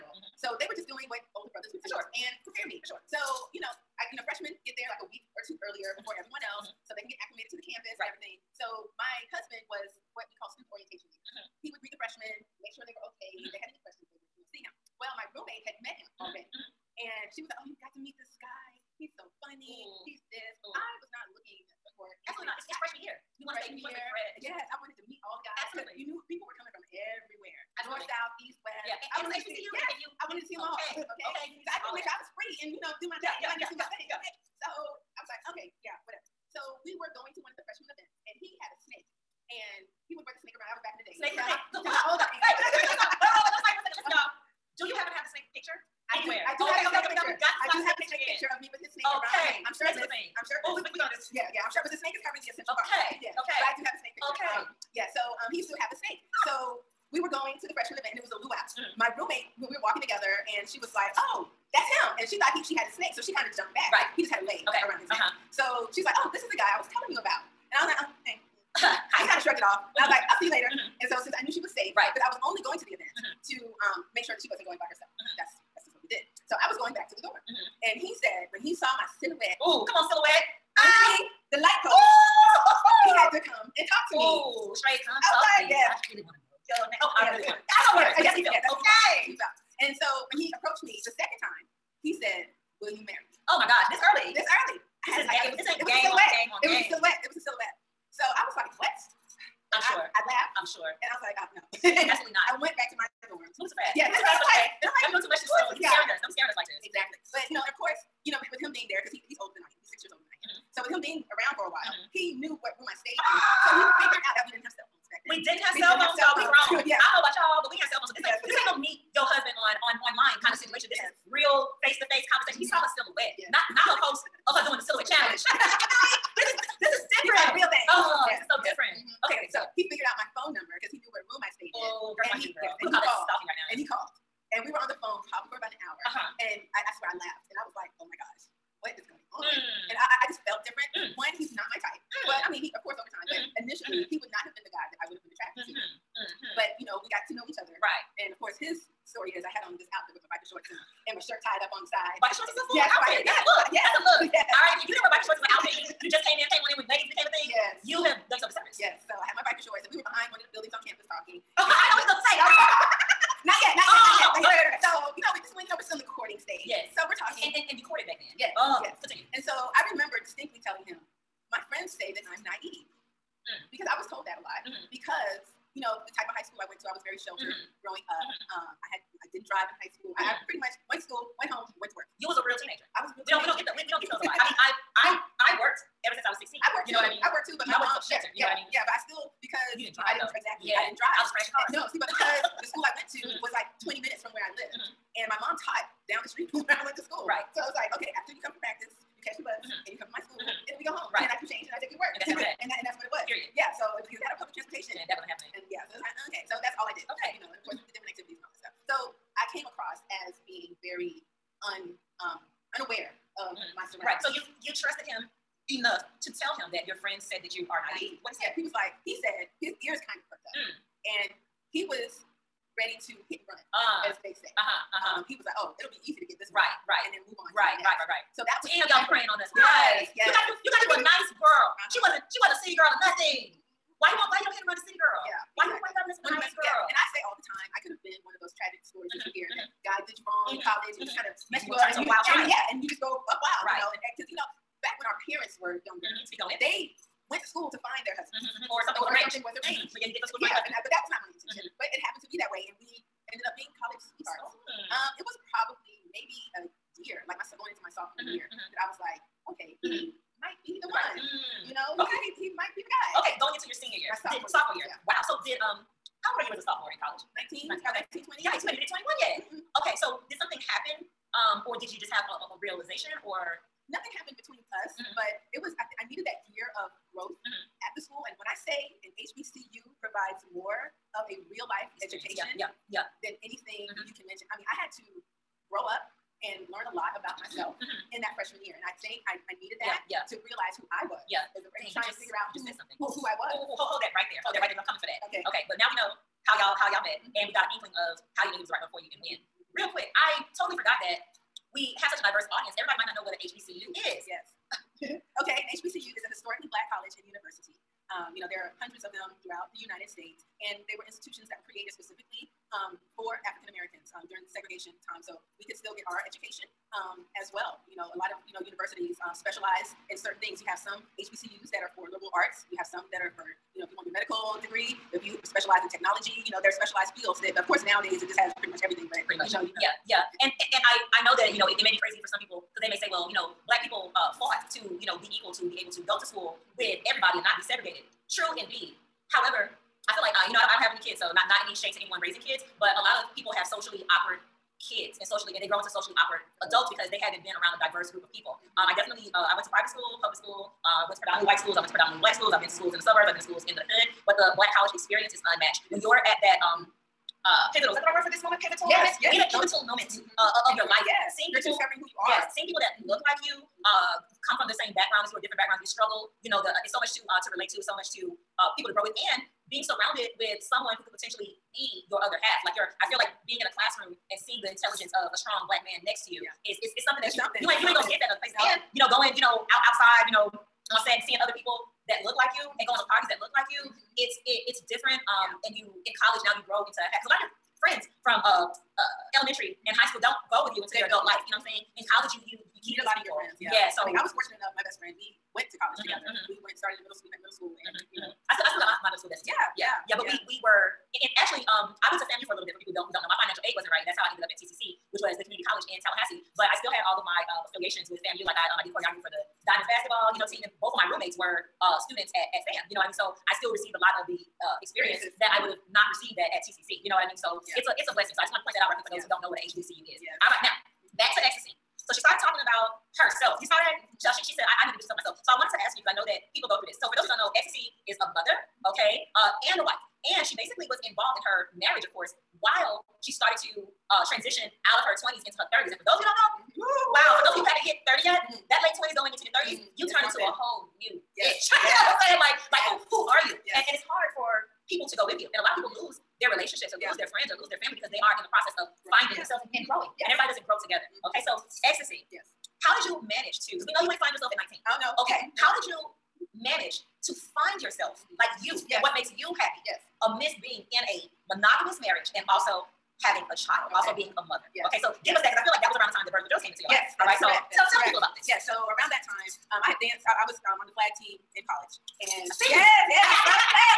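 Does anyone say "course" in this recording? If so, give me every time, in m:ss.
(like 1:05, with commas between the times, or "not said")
5:27, 7:12.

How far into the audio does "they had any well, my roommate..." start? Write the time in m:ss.
0:13.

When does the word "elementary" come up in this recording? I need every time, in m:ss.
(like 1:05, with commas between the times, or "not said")
6:29.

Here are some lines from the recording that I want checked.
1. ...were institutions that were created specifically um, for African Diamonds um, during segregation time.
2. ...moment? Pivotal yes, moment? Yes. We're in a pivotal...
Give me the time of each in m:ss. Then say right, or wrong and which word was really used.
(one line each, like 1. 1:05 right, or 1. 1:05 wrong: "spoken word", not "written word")
1. 5:10 wrong: "Americans", not "Diamonds"
2. 5:58 right.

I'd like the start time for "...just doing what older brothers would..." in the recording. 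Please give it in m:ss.
0:00.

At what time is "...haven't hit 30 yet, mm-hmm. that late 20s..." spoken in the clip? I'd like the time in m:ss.
7:17.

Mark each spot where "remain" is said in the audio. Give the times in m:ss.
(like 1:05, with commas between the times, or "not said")
not said.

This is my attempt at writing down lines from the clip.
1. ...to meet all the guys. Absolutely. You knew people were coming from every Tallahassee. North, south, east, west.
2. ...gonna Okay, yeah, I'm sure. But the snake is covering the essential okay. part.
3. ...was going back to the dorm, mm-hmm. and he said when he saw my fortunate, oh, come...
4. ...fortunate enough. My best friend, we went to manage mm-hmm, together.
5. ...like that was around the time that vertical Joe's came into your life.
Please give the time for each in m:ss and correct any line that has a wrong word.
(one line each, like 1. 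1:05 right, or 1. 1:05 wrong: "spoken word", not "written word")
1. 0:24 wrong: "Absolutely", not "Tallahassee"
2. 0:50 wrong: "Yeah", not "Okay"
3. 1:16 wrong: "silhouette", not "fortunate"
4. 6:34 wrong: "college", not "manage"
5. 7:45 right.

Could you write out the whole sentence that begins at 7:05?
So I wanted to ask you, because I know that people go through this.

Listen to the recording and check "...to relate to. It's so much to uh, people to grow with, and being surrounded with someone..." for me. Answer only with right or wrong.
right.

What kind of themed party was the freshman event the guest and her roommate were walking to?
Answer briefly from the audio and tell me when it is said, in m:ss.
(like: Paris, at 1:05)
A luau, at 0:58.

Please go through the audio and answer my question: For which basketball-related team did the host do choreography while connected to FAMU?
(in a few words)
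The Diamonds.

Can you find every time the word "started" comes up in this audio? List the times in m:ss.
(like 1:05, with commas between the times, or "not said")
6:36, 7:02, 7:13.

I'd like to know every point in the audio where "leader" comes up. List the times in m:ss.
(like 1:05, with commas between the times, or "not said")
0:11.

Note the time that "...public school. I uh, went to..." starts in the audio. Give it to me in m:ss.
5:50.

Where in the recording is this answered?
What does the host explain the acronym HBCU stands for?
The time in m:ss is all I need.
5:06.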